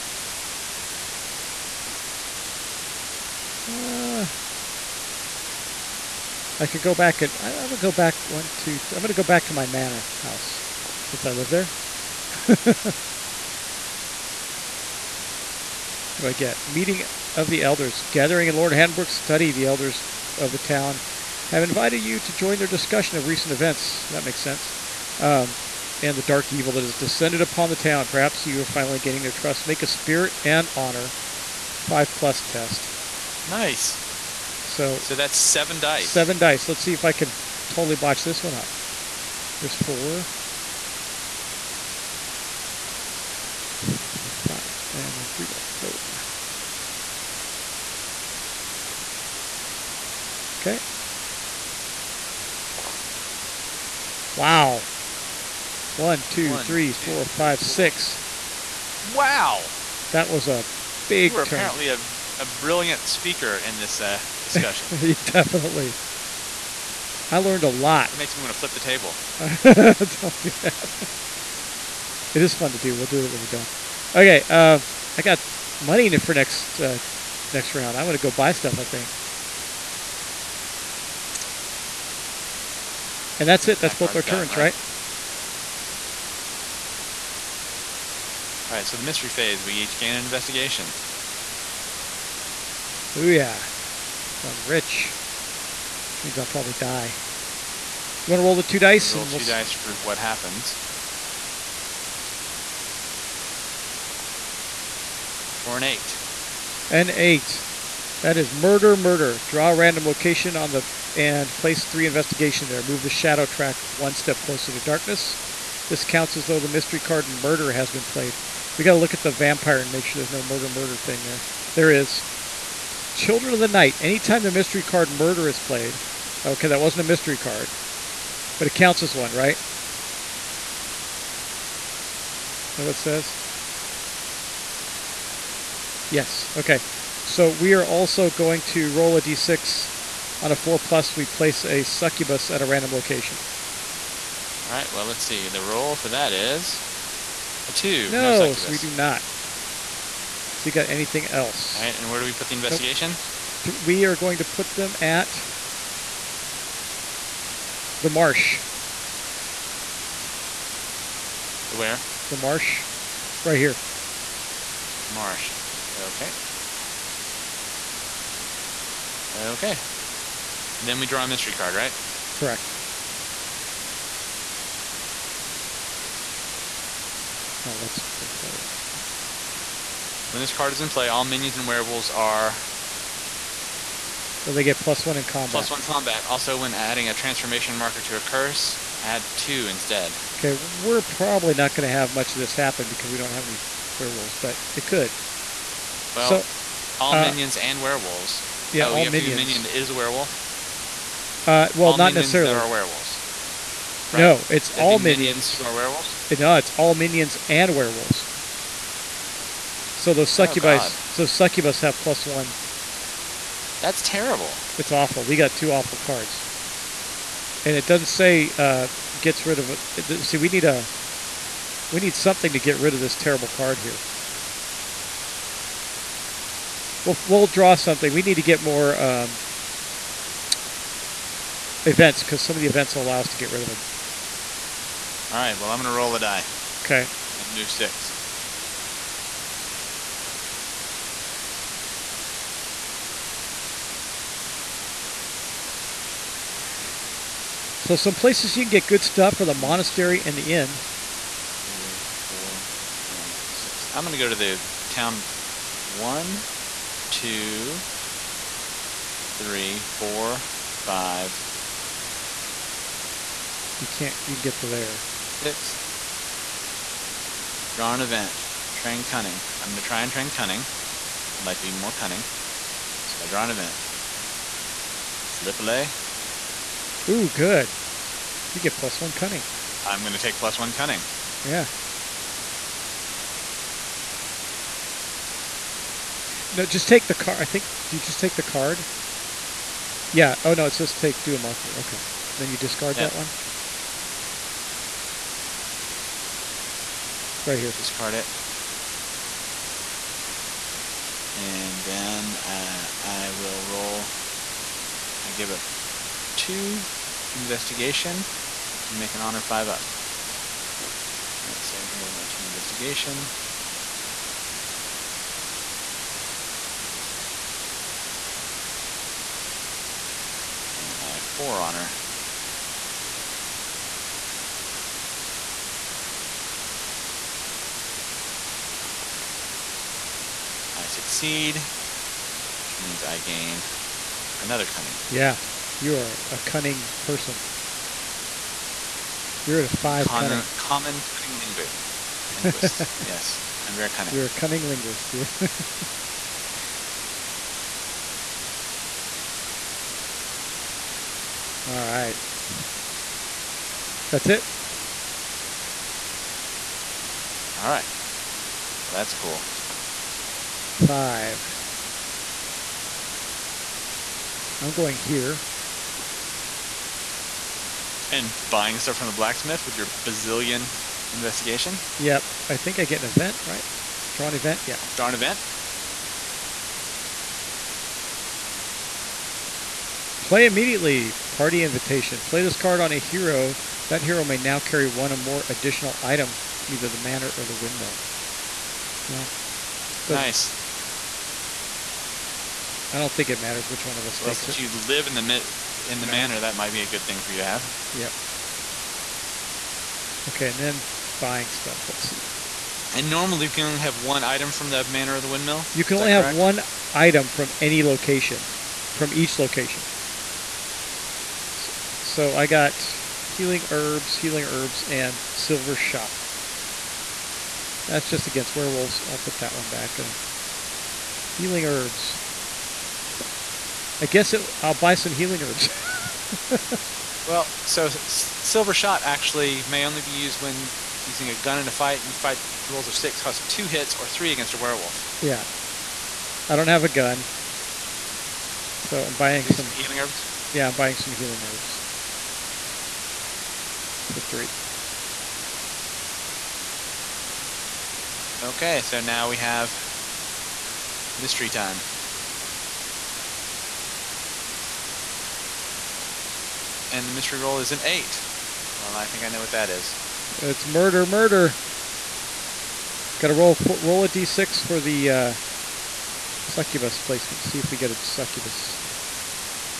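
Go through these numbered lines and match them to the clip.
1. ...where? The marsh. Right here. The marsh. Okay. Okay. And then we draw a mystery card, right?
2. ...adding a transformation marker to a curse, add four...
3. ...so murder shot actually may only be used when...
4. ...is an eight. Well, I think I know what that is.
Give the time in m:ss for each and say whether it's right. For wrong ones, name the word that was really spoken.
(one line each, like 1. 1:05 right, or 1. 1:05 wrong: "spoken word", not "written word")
1. 2:41 right
2. 3:06 wrong: "two", not "four"
3. 7:07 wrong: "silver", not "murder"
4. 7:37 right.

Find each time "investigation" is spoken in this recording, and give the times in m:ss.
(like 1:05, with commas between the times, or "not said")
1:30, 1:52, 2:32, 5:07, 5:12, 6:11.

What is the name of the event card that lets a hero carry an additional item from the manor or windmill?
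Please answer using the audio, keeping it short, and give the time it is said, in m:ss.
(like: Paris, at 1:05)
Party invitation, at 6:21.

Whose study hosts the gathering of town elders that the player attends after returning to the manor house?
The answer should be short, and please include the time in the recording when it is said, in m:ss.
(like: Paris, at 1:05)
Lord Hanbrook, at 0:18.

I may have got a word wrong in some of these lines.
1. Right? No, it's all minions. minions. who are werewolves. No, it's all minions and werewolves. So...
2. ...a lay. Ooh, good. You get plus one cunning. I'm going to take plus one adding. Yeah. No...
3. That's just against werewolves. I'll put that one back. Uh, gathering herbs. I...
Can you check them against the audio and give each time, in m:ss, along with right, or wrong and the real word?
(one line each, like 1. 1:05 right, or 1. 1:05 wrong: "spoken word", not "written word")
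1. 3:24 right
2. 4:35 wrong: "cunning", not "adding"
3. 6:57 wrong: "healing", not "gathering".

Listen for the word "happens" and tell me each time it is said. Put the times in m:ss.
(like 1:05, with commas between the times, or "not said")
1:40, 3:12.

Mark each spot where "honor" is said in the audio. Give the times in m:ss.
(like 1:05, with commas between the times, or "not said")
0:30, 5:09, 5:21.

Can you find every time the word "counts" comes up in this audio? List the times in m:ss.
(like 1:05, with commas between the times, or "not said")
1:56, 2:08.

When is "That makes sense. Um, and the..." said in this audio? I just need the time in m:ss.
0:24.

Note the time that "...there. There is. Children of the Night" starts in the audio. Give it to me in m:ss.
2:01.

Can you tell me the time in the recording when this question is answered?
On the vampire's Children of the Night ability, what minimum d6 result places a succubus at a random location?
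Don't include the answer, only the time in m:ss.
2:20.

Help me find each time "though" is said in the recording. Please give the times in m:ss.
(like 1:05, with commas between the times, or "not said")
1:56.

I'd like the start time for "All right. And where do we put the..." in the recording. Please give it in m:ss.
2:31.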